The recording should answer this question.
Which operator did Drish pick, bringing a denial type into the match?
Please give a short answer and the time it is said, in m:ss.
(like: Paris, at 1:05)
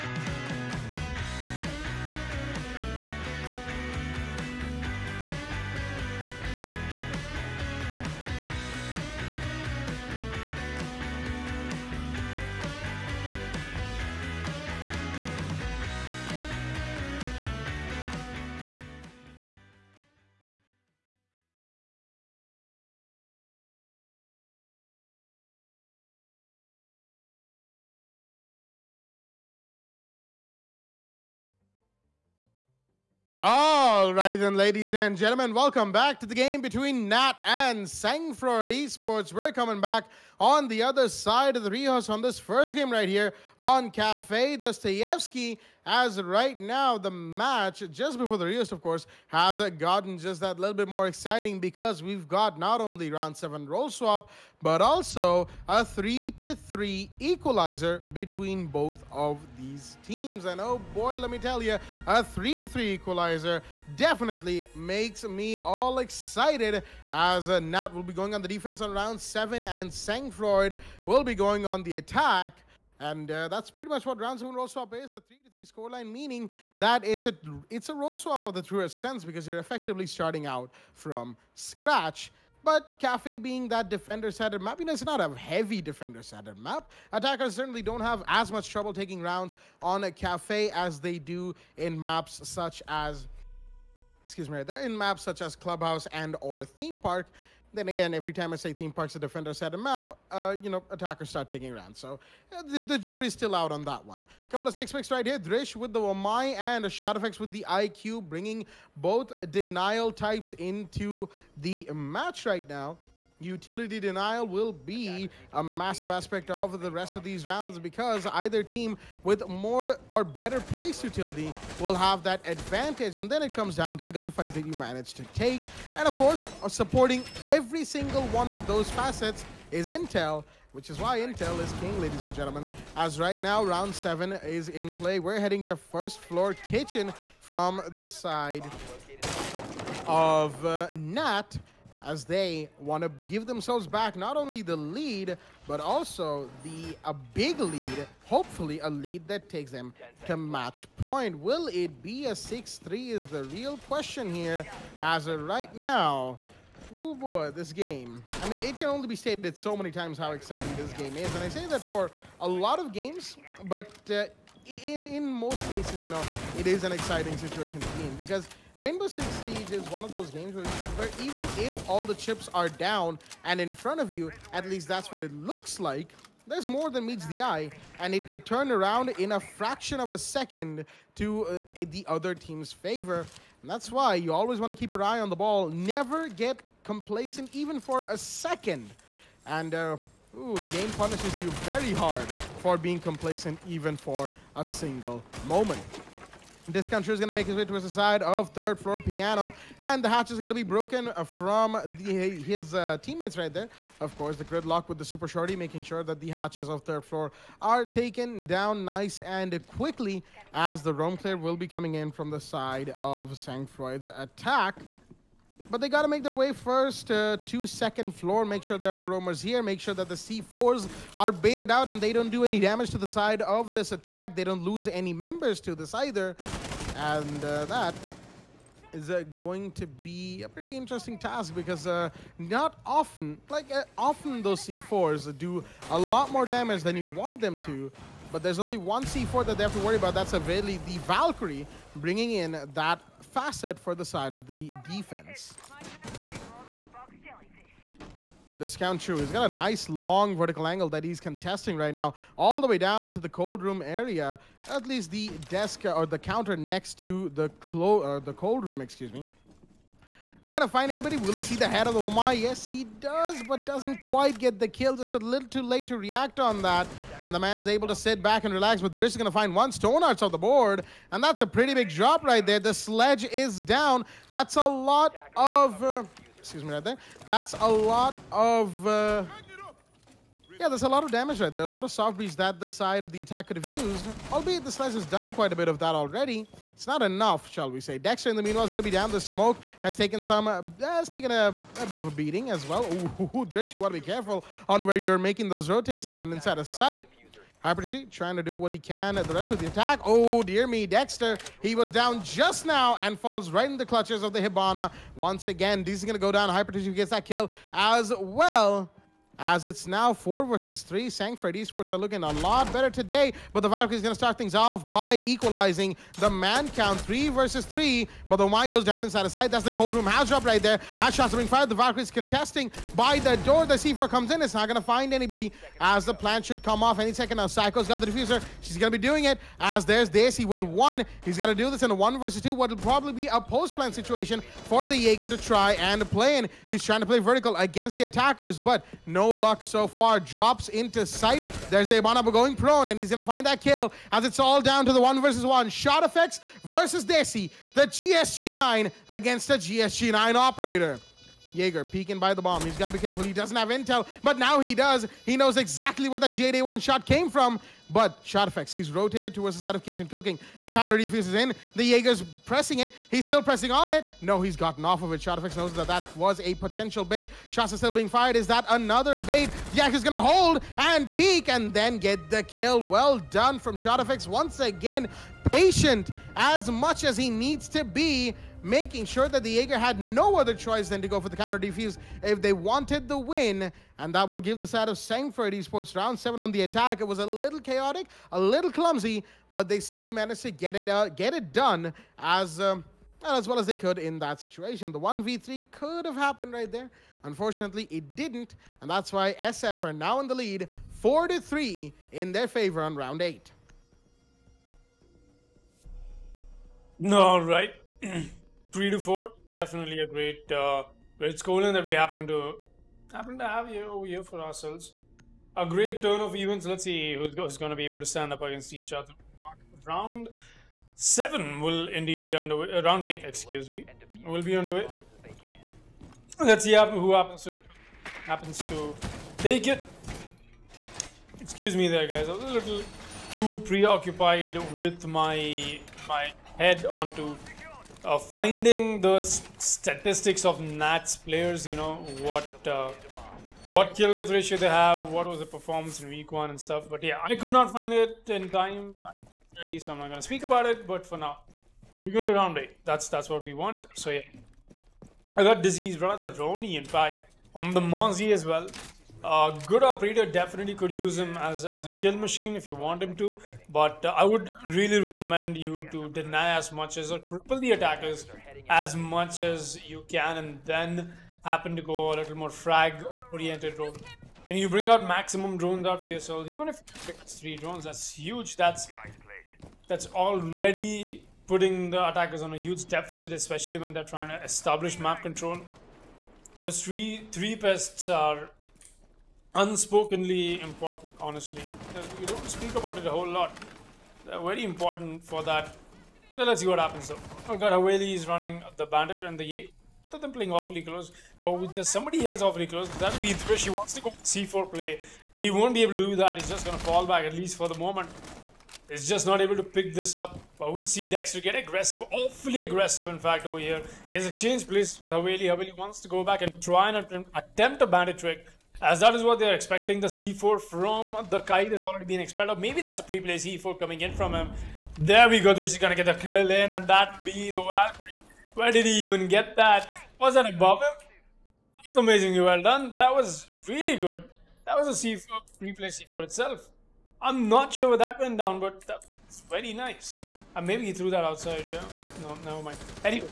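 Wamai, at 1:45.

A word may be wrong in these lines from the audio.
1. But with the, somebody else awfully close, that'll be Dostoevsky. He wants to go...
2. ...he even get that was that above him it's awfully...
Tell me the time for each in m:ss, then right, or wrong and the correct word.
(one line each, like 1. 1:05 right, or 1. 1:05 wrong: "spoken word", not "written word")
1. 8:21 wrong: "Drish", not "Dostoevsky"
2. 8:48 wrong: "amazingly", not "awfully".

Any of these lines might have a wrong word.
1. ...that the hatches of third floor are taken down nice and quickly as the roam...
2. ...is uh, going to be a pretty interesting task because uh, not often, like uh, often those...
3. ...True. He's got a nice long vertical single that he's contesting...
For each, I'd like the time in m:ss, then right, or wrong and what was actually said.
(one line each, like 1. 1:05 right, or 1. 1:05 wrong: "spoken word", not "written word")
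1. 3:26 right
2. 3:48 right
3. 4:09 wrong: "angle", not "single".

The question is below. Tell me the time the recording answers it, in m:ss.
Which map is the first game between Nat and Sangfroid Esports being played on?
0:43.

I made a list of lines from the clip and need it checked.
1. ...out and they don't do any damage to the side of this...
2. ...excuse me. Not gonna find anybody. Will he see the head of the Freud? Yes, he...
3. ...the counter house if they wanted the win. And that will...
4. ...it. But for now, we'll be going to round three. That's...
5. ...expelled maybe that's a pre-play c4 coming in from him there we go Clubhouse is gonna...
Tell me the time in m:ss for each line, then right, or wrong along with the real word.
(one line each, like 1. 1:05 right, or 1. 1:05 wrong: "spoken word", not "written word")
1. 3:41 right
2. 4:18 wrong: "Umar", not "Freud"
3. 6:21 wrong: "defuse", not "house"
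4. 7:30 wrong: "eight", not "three"
5. 8:42 wrong: "Drish", not "Clubhouse".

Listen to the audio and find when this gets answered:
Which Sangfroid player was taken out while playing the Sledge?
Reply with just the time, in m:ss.
4:29.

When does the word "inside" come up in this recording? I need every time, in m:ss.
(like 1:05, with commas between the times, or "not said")
4:56, 5:19.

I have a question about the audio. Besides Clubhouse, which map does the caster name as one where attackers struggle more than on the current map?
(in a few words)
Theme Park.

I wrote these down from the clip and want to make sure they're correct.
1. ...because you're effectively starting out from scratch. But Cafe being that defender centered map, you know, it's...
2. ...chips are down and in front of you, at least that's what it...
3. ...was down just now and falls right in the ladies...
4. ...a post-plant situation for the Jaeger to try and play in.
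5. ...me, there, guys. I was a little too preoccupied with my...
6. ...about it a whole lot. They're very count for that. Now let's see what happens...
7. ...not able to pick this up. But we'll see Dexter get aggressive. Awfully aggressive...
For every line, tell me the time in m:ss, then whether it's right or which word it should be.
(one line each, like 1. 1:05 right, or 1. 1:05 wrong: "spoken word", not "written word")
1. 1:19 right
2. 2:52 right
3. 5:01 wrong: "clutches", not "ladies"
4. 5:33 right
5. 7:11 right
6. 8:12 wrong: "important", not "count"
7. 8:29 right.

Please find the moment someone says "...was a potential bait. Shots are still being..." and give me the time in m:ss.
6:06.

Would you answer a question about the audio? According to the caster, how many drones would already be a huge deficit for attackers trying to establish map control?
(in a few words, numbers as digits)
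3.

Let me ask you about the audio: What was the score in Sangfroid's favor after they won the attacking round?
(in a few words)
4 to 3.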